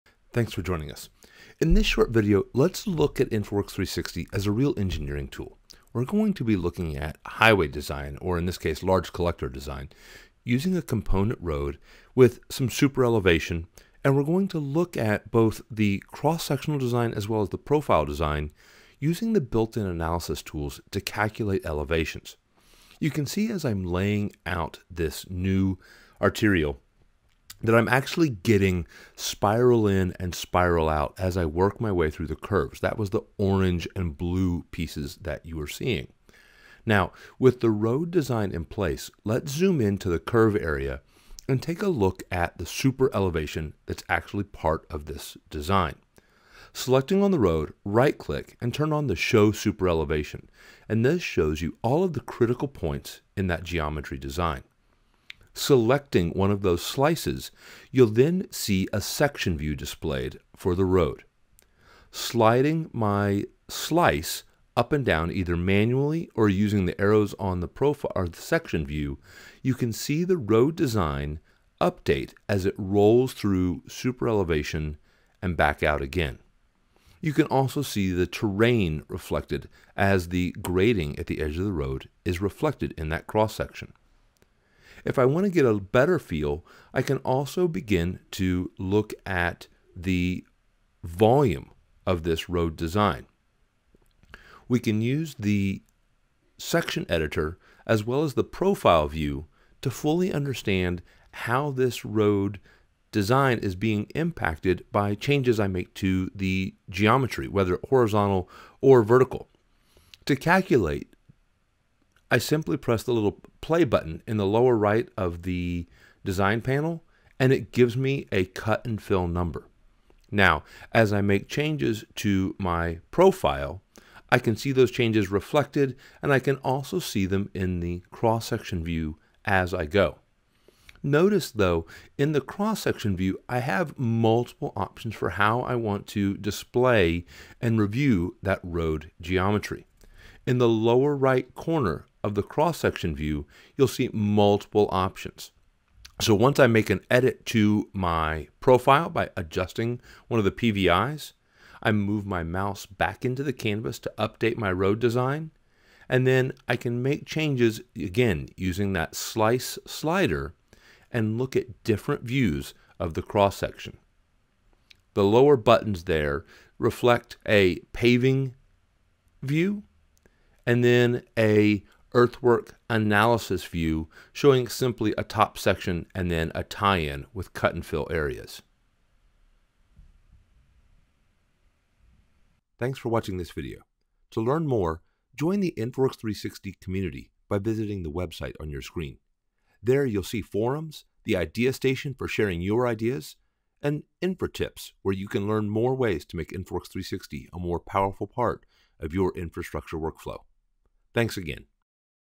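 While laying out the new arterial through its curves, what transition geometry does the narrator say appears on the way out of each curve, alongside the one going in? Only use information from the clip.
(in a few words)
Spiral out.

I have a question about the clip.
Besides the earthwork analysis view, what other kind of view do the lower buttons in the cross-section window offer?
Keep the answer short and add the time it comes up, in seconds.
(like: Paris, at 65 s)
Paving view, at 167 s.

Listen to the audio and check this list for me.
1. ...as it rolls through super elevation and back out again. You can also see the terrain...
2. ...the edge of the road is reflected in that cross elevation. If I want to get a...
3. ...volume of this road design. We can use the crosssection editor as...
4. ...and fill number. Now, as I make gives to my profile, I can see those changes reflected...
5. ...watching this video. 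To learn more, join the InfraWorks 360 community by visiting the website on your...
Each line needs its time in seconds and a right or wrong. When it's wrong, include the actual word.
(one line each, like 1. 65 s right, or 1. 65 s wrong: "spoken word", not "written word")
1. 72 s right
2. 81 s wrong: "section", not "elevation"
3. 91 s wrong: "section", not "crosssection"
4. 118 s wrong: "changes", not "gives"
5. 183 s right.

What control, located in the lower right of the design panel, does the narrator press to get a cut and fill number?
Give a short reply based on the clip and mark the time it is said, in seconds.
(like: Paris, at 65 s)
Play button, at 113 s.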